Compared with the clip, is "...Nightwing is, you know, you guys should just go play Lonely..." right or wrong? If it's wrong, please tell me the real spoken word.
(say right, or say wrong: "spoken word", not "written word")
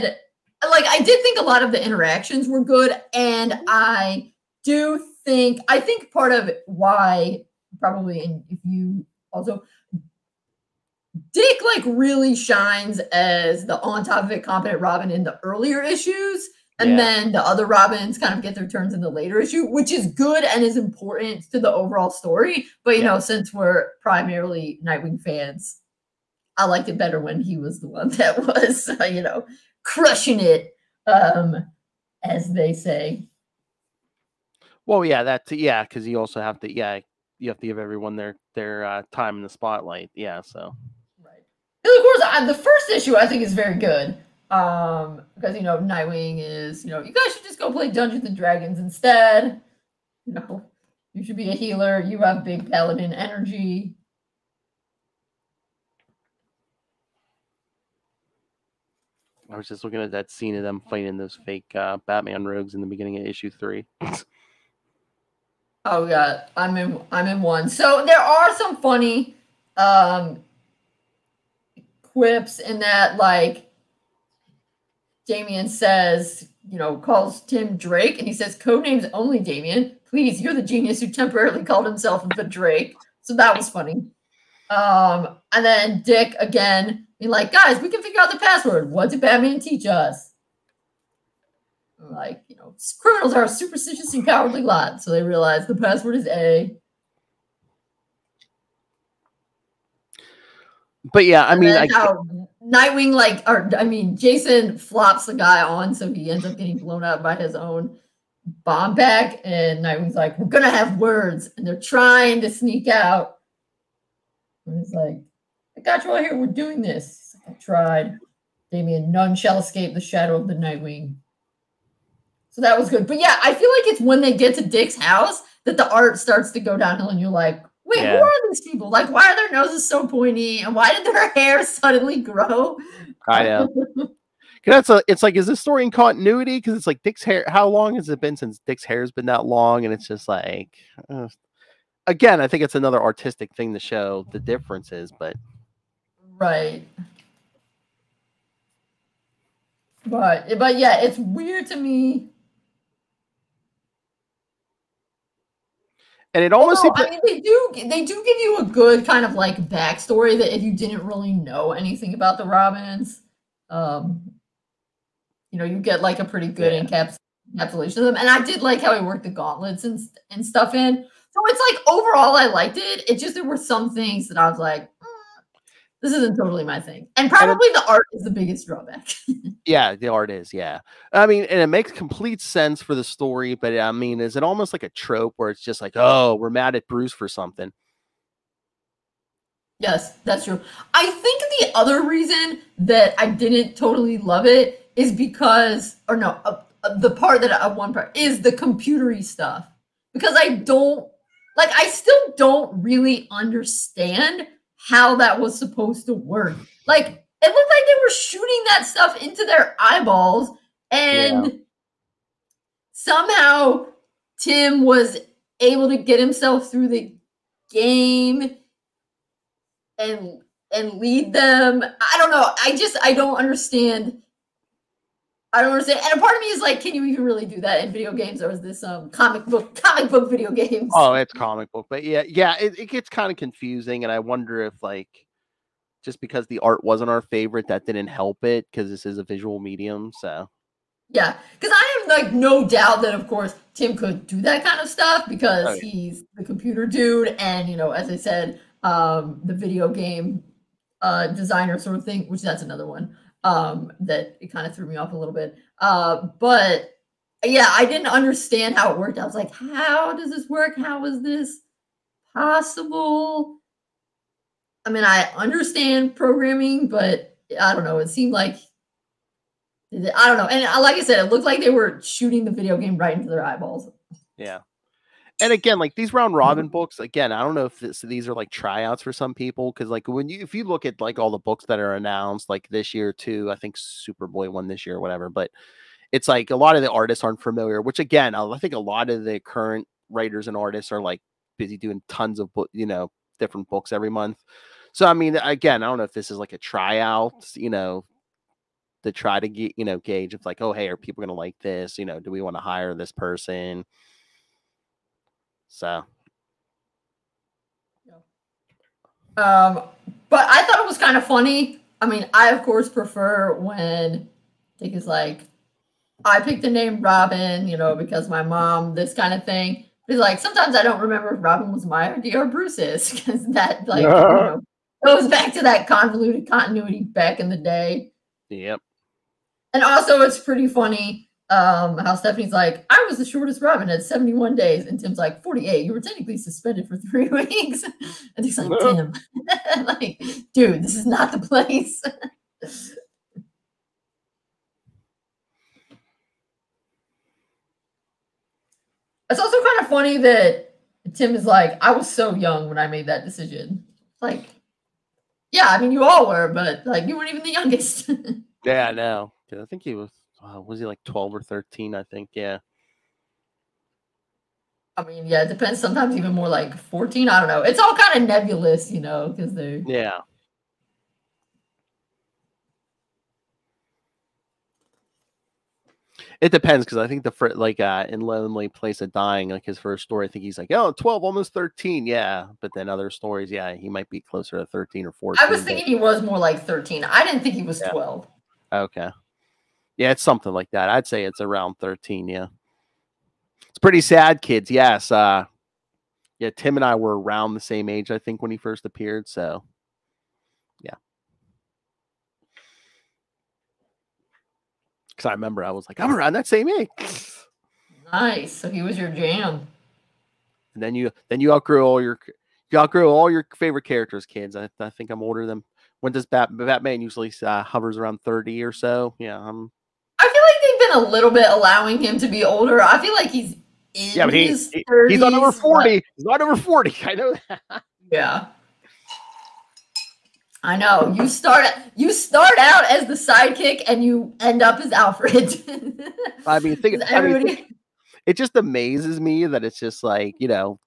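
wrong: "Dungeons", not "Lonely".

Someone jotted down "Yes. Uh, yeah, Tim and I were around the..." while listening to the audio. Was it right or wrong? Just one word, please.
right.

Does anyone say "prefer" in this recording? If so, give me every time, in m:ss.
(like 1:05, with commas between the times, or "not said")
5:12.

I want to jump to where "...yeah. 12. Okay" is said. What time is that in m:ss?
6:27.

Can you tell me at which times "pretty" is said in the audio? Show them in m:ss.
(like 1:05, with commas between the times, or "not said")
2:46, 5:30, 6:33.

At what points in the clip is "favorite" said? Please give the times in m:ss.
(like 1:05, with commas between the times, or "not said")
3:57, 6:53.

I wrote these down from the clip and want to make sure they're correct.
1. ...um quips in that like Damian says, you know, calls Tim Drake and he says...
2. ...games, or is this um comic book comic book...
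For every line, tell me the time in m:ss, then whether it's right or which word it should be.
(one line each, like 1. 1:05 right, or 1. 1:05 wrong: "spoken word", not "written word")
1. 1:09 right
2. 3:48 right.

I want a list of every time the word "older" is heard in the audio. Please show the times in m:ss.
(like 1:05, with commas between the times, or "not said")
6:55, 7:02.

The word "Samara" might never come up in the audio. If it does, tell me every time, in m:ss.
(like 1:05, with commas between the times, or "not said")
not said.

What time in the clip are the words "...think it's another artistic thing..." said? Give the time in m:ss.
2:22.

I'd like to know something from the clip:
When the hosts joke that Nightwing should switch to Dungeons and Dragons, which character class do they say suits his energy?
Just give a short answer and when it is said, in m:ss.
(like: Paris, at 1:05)
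Paladin, at 0:52.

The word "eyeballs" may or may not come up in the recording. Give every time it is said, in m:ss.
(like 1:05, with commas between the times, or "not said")
3:29, 4:33.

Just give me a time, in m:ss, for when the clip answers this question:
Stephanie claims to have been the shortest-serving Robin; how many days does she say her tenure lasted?
5:34.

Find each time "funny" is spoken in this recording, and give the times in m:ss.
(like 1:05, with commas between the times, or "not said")
1:08, 1:23, 5:11, 5:30, 5:49.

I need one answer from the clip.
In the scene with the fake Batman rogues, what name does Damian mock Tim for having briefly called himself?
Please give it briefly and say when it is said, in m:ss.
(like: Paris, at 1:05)
The Drake, at 1:22.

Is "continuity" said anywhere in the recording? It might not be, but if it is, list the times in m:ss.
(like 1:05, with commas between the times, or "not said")
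2:15, 5:26.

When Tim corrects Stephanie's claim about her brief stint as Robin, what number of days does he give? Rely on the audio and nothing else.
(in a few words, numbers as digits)
48.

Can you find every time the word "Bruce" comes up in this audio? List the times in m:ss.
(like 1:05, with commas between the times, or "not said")
3:06, 5:22.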